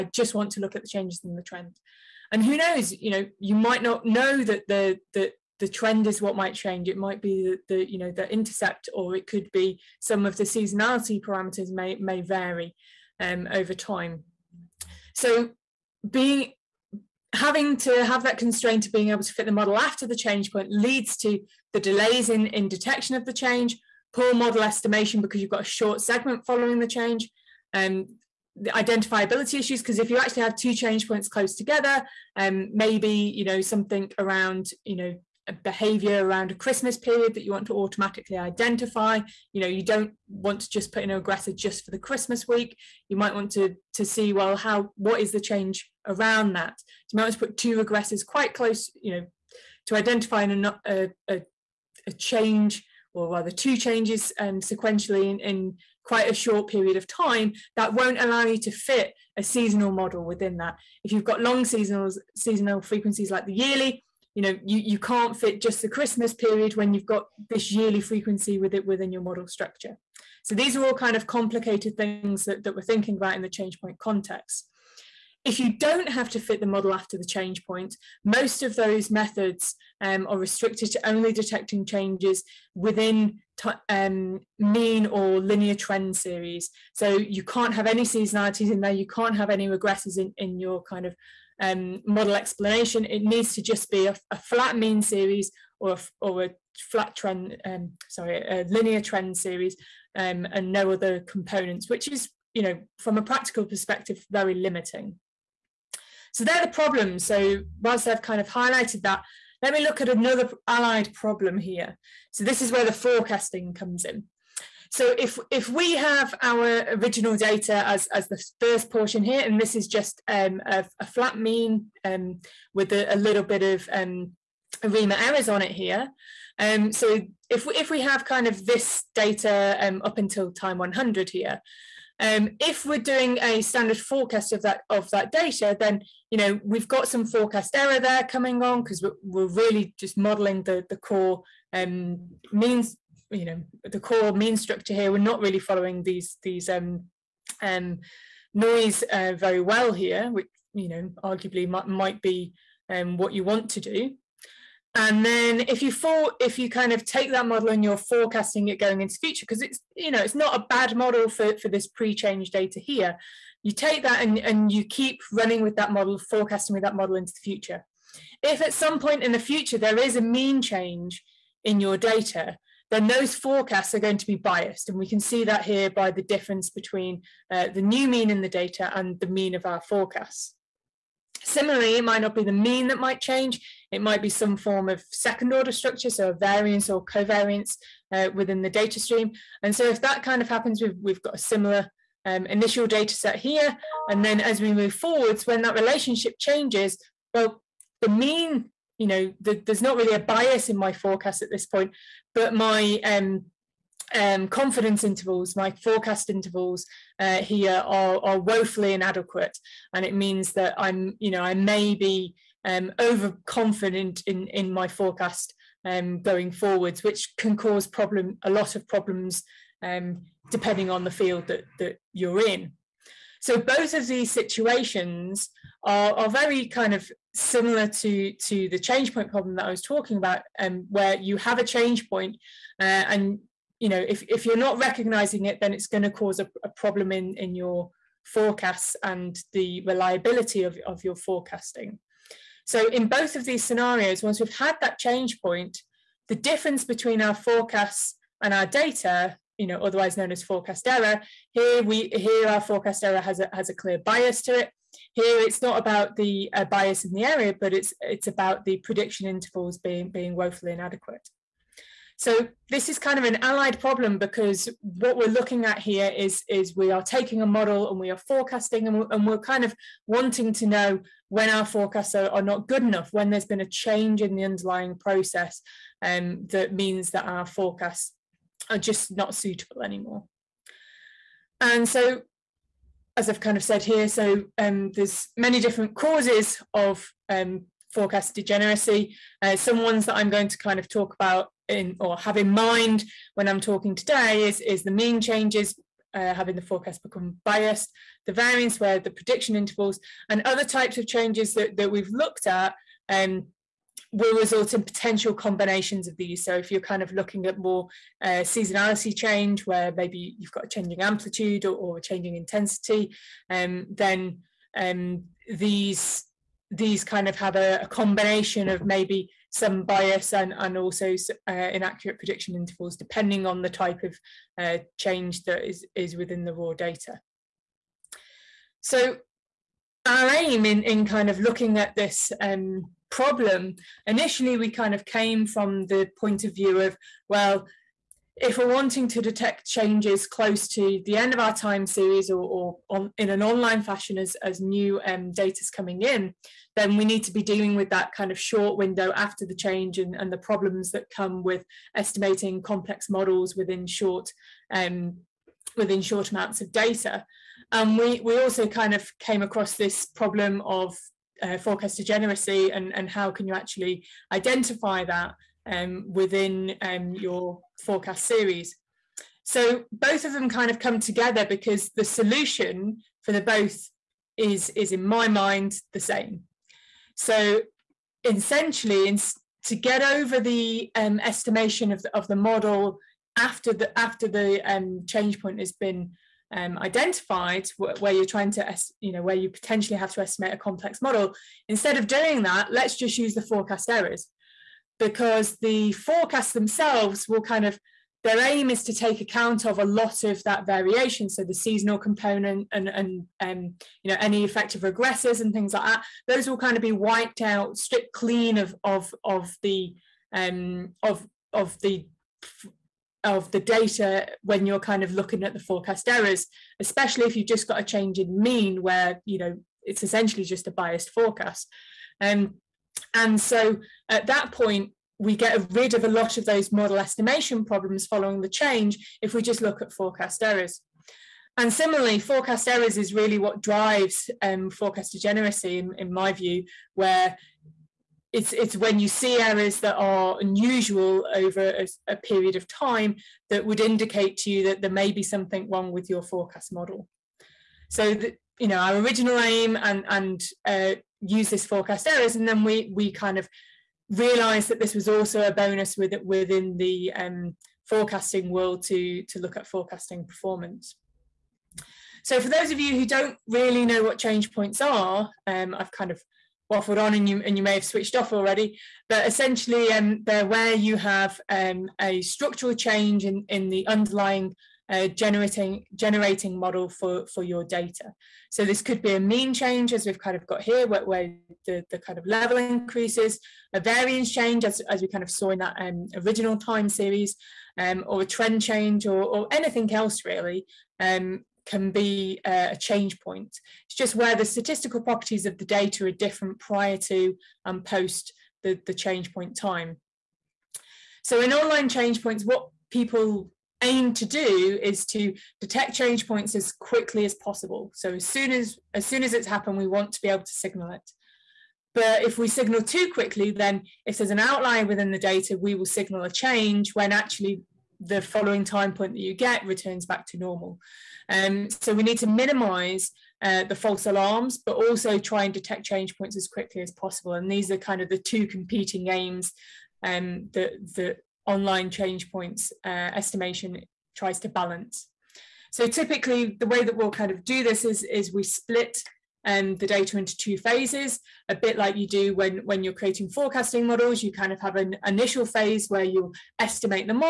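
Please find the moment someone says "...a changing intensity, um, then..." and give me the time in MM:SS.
05:11.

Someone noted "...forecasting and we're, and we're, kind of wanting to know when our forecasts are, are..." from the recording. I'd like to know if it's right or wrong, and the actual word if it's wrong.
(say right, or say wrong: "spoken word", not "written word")
right.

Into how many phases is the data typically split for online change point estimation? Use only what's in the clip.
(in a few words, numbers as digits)
2.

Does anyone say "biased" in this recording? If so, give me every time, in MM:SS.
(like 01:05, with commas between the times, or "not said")
02:54, 04:57, 07:00.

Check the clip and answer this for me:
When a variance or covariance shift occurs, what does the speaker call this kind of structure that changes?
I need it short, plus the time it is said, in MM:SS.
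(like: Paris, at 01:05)
second order structure, at 03:05.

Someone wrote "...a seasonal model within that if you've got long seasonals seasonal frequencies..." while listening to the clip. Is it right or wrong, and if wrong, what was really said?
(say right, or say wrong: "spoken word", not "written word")
right.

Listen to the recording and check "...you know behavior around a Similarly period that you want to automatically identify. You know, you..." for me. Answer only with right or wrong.
wrong.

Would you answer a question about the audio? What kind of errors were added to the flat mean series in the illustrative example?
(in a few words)
ARIMA errors.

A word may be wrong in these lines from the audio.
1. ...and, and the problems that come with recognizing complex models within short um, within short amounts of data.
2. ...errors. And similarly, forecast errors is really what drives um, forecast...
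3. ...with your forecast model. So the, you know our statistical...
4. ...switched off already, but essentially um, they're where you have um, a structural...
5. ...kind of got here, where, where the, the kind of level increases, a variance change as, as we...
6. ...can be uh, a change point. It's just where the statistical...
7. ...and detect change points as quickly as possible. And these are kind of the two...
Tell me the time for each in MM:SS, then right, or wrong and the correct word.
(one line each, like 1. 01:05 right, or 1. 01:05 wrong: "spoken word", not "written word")
1. 05:49 wrong: "estimating", not "recognizing"
2. 07:10 right
3. 07:25 wrong: "original", not "statistical"
4. 07:47 right
5. 08:00 right
6. 08:11 right
7. 08:45 right.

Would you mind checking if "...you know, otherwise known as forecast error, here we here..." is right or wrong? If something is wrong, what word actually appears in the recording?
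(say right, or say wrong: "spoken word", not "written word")
right.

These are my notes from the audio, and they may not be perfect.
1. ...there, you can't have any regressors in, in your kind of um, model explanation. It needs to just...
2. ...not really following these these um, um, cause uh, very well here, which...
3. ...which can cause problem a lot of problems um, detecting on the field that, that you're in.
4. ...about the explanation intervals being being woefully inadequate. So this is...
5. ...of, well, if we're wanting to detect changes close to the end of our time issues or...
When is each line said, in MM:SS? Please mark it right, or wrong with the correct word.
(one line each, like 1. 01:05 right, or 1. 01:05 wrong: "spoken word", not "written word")
1. 01:28 right
2. 02:25 wrong: "noise", not "cause"
3. 03:37 wrong: "depending", not "detecting"
4. 04:18 wrong: "prediction", not "explanation"
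5. 05:36 wrong: "series", not "issues".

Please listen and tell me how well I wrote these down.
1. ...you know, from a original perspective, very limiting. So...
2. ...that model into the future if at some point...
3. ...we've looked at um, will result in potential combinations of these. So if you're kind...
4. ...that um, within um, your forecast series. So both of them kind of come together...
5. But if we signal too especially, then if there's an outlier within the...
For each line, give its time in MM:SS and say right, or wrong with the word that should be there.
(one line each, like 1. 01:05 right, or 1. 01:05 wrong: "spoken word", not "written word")
1. 01:42 wrong: "practical", not "original"
2. 02:46 right
3. 05:01 right
4. 06:05 right
5. 08:31 wrong: "quickly", not "especially".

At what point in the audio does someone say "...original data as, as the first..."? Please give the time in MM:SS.
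01:56.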